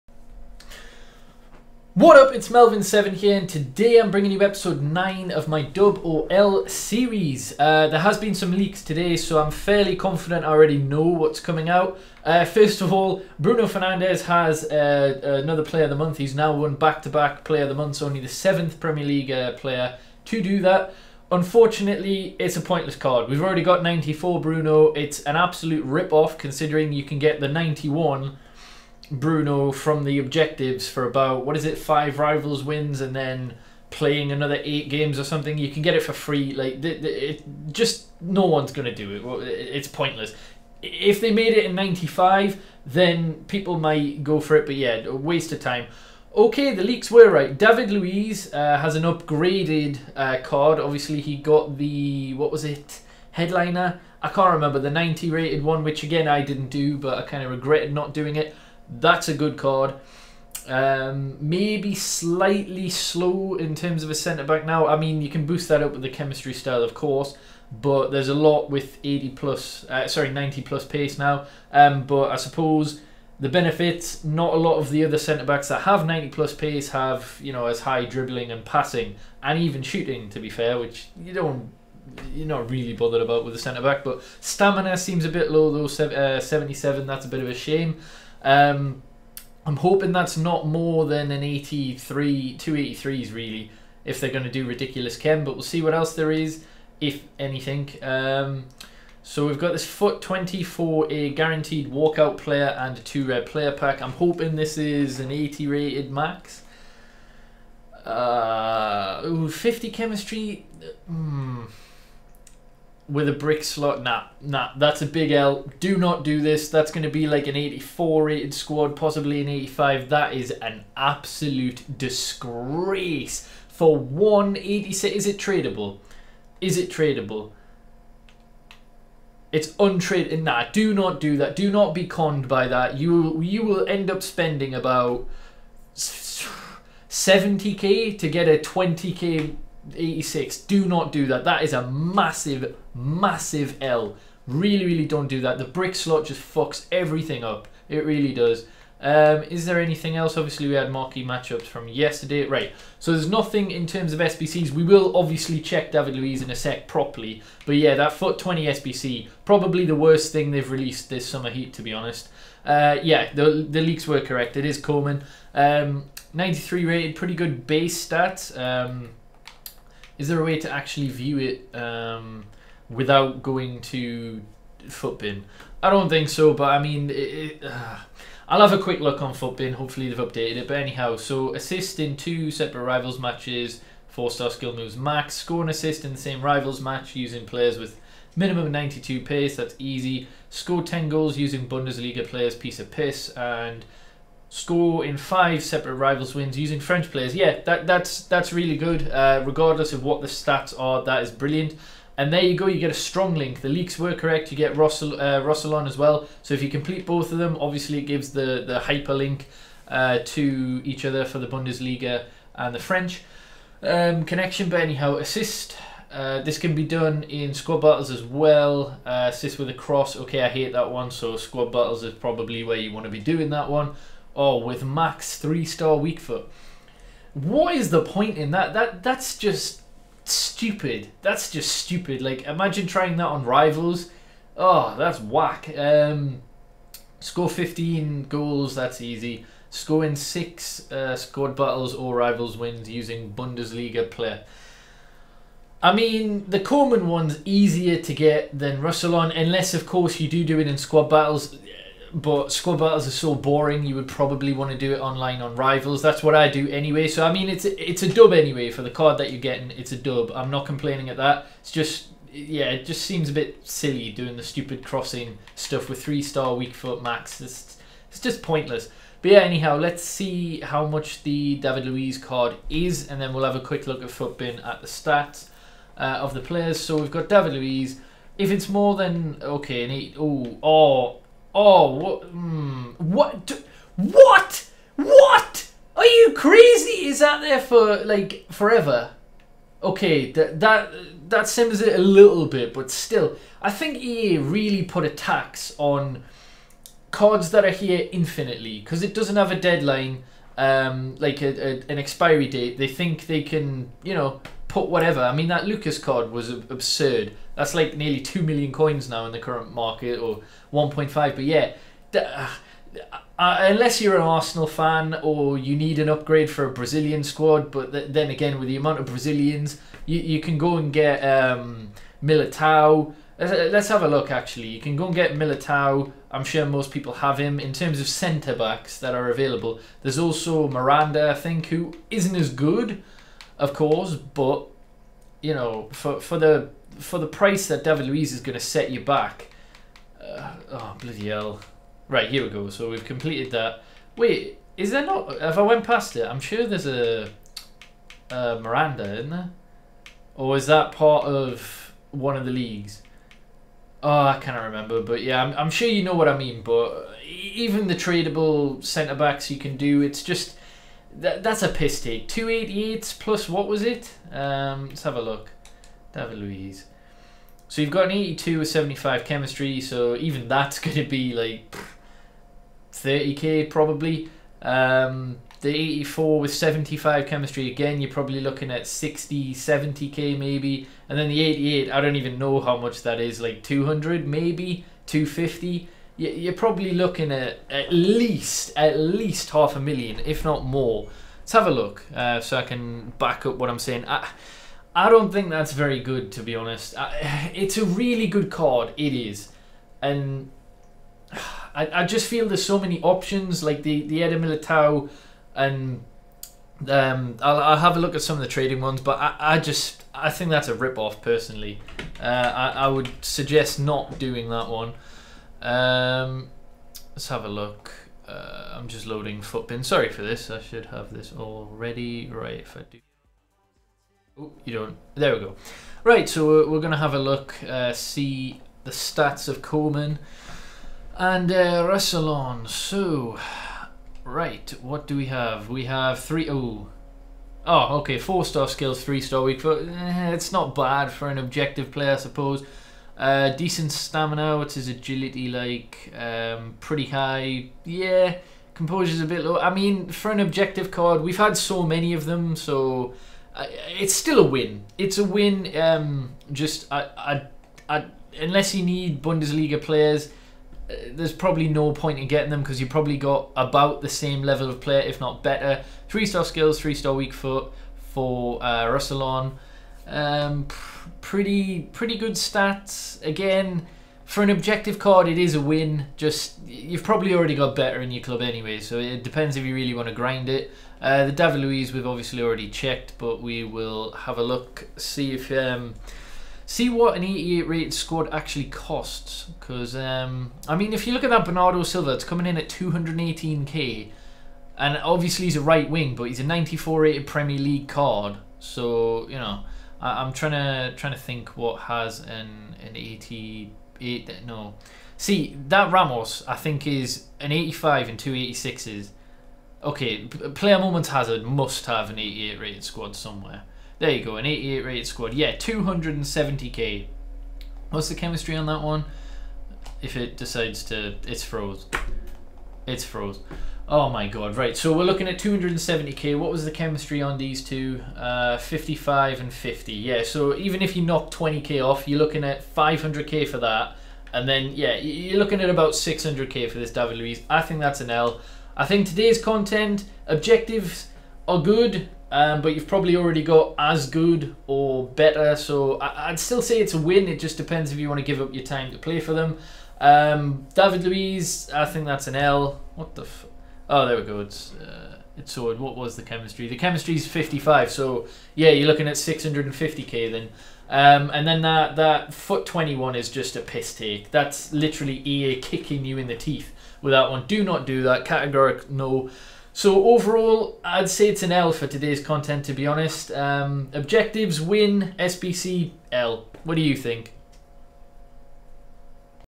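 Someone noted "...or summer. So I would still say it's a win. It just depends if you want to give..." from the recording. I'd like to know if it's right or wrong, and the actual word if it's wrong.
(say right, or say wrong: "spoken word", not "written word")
wrong: "better", not "summer".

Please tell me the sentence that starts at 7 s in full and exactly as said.
Uh, there has been some leaks today, so I'm fairly confident I already know what's coming out.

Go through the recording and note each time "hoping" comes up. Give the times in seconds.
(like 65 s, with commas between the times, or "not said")
89 s, 104 s.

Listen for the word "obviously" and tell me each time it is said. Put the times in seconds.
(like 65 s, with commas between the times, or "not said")
50 s, 150 s, 155 s, 207 s, 482 s, 494 s.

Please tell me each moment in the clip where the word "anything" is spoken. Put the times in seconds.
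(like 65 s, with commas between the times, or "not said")
97 s, 149 s.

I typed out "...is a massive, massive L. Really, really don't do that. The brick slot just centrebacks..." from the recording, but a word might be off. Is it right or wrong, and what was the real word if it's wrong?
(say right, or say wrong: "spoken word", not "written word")
wrong: "fucks", not "centrebacks".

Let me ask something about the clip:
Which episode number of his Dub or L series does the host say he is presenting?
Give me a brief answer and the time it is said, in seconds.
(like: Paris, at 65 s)
9, at 4 s.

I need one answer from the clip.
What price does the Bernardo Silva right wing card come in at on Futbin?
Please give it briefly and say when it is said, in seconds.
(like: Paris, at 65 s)
218k, at 492 s.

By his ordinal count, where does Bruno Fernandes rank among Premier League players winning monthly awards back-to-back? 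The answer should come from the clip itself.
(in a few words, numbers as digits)
7th.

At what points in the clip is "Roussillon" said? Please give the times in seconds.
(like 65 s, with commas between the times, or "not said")
205 s, 248 s.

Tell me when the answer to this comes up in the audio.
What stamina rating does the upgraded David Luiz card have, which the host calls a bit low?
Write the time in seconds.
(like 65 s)
86 s.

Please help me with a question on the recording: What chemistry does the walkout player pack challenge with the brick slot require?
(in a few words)
50.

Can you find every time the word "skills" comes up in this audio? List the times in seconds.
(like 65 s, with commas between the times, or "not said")
184 s, 438 s, 466 s.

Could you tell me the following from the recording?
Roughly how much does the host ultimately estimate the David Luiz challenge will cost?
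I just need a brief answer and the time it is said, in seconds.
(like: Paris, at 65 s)
650k, at 559 s.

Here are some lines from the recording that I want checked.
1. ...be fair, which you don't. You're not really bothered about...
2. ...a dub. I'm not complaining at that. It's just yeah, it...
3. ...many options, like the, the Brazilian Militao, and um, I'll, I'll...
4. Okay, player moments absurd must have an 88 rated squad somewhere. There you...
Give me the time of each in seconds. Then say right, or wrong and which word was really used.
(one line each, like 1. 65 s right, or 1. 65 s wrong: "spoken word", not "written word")
1. 80 s right
2. 259 s right
3. 402 s wrong: "Eder", not "Brazilian"
4. 509 s wrong: "hazard", not "absurd".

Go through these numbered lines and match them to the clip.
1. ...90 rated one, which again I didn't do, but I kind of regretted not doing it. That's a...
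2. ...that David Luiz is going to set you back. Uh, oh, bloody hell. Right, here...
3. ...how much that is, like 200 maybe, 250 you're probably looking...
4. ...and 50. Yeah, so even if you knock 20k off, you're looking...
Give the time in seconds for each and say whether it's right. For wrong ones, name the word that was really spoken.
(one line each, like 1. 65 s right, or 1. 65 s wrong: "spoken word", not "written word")
1. 54 s right
2. 337 s right
3. 382 s right
4. 529 s right.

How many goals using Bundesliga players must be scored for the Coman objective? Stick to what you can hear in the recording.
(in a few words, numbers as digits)
10.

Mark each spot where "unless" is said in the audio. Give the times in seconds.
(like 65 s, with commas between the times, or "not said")
249 s, 313 s, 458 s.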